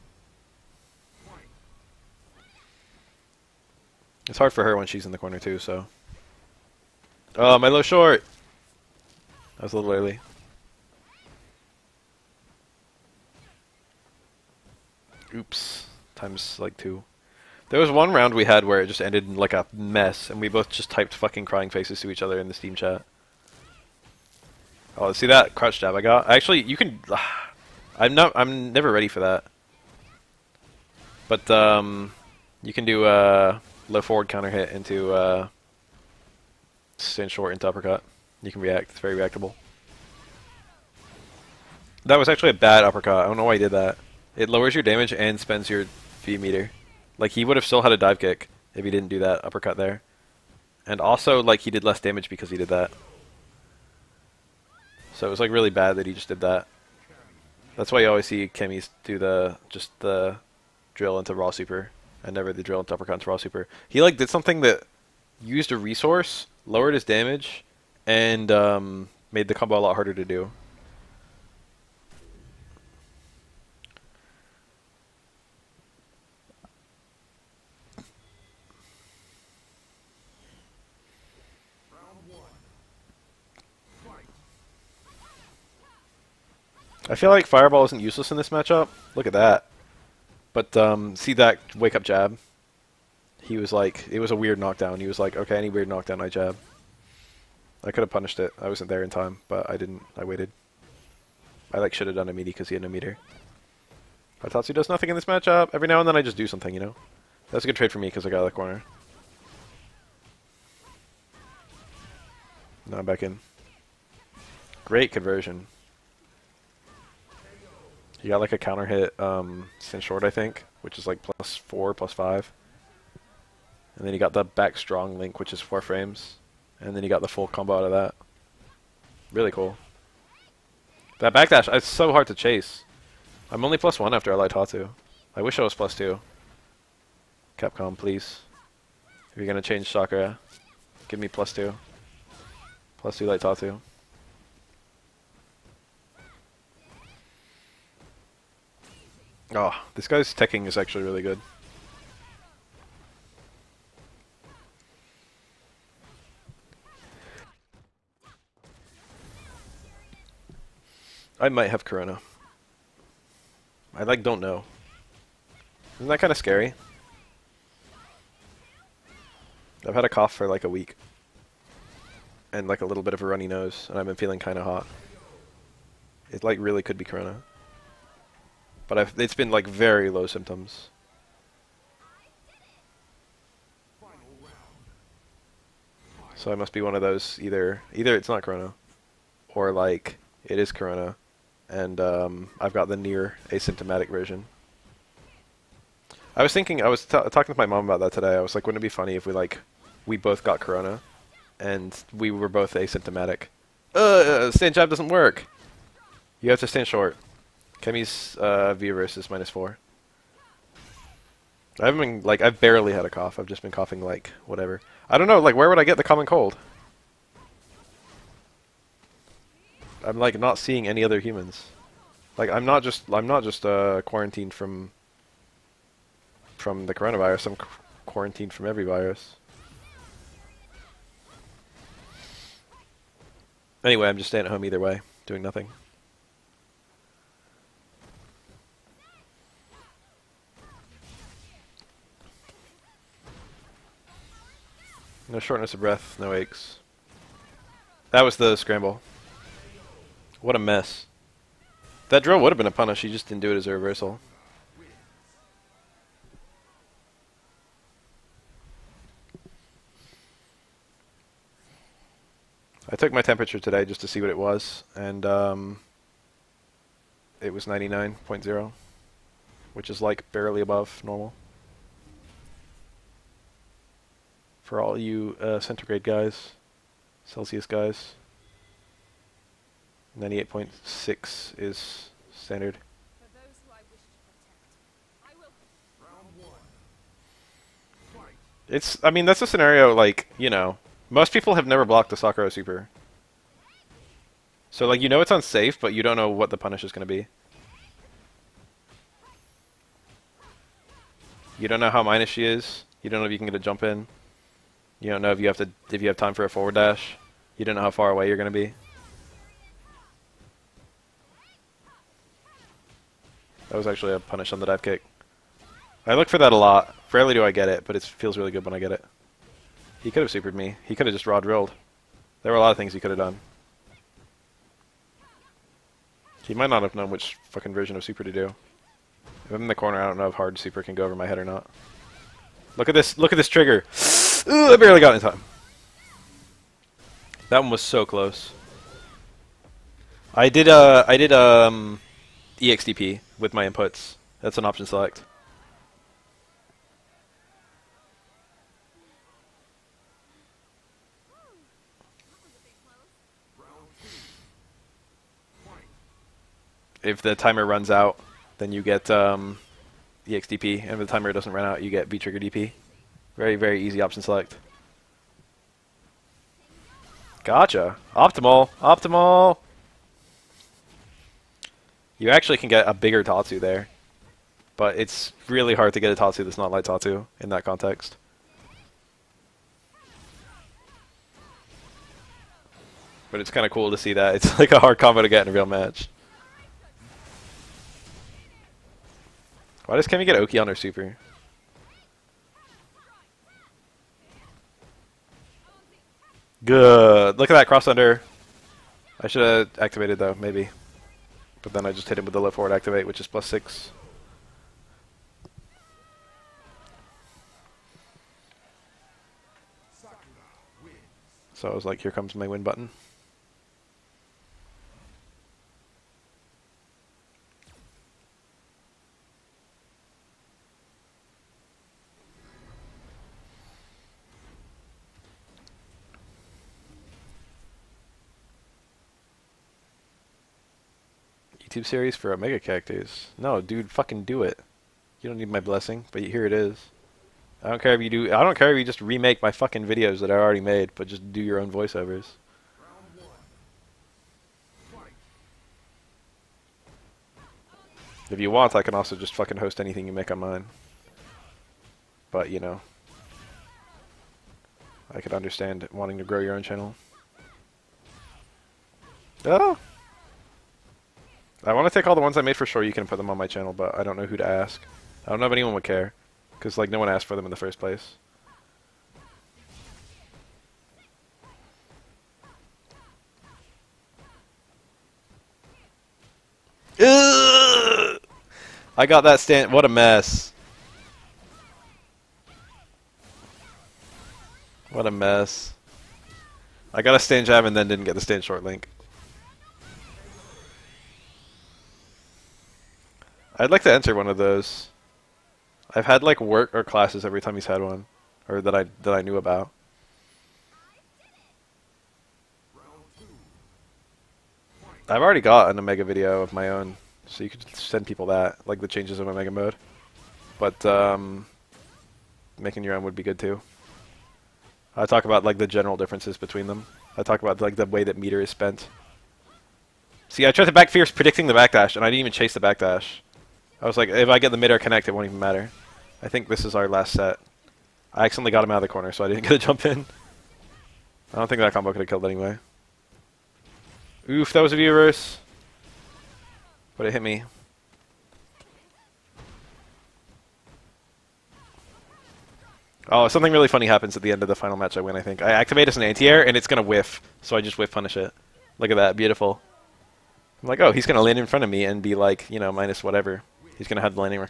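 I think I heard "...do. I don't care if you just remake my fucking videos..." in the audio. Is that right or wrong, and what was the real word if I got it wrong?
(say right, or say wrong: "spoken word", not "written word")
right.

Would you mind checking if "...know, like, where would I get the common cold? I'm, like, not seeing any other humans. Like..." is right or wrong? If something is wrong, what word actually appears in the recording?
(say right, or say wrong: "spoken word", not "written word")
right.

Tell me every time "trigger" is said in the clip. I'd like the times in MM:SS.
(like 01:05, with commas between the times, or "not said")
05:33, 06:02.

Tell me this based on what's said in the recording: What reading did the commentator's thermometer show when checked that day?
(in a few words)
99.0.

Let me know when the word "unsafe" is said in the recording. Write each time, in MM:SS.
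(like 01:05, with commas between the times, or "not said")
04:55.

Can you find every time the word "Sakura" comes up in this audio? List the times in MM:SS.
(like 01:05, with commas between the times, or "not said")
02:19, 04:52.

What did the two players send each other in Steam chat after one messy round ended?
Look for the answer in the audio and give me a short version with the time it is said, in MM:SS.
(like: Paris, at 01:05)
crying faces, at 00:21.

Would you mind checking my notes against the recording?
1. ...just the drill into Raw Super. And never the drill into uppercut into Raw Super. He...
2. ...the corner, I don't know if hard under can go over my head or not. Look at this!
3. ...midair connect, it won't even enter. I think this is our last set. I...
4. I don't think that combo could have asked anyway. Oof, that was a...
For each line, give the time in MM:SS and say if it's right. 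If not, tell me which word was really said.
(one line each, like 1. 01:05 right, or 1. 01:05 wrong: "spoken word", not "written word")
1. 00:59 right
2. 05:29 wrong: "super", not "under"
3. 08:44 wrong: "matter", not "enter"
4. 08:51 wrong: "killed", not "asked".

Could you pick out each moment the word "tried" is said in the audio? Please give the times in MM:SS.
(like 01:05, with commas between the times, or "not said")
08:40.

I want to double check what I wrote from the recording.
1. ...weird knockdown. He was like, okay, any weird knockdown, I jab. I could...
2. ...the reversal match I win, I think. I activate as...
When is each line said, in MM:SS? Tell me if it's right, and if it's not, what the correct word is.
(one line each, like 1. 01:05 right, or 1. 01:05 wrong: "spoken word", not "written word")
1. 01:34 right
2. 09:04 wrong: "final", not "reversal".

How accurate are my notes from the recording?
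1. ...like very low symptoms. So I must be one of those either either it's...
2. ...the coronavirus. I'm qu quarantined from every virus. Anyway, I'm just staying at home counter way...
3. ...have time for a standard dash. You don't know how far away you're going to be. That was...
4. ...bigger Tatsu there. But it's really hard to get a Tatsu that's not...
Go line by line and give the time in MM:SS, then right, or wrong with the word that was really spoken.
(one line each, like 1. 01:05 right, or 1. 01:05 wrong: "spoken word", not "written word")
1. 02:59 right
2. 03:46 wrong: "either", not "counter"
3. 05:06 wrong: "forward", not "standard"
4. 06:12 right.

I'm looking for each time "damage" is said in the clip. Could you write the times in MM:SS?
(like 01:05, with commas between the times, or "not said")
00:44, 00:51, 01:07.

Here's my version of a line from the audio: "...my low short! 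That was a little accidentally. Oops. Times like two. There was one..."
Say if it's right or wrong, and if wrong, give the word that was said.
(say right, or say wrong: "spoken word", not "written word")
wrong: "early", not "accidentally".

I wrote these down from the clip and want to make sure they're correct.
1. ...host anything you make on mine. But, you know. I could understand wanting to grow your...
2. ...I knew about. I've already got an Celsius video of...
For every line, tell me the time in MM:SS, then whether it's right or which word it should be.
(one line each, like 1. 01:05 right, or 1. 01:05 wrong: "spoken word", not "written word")
1. 07:29 right
2. 08:19 wrong: "Omega", not "Celsius".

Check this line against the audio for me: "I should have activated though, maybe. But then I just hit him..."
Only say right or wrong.
right.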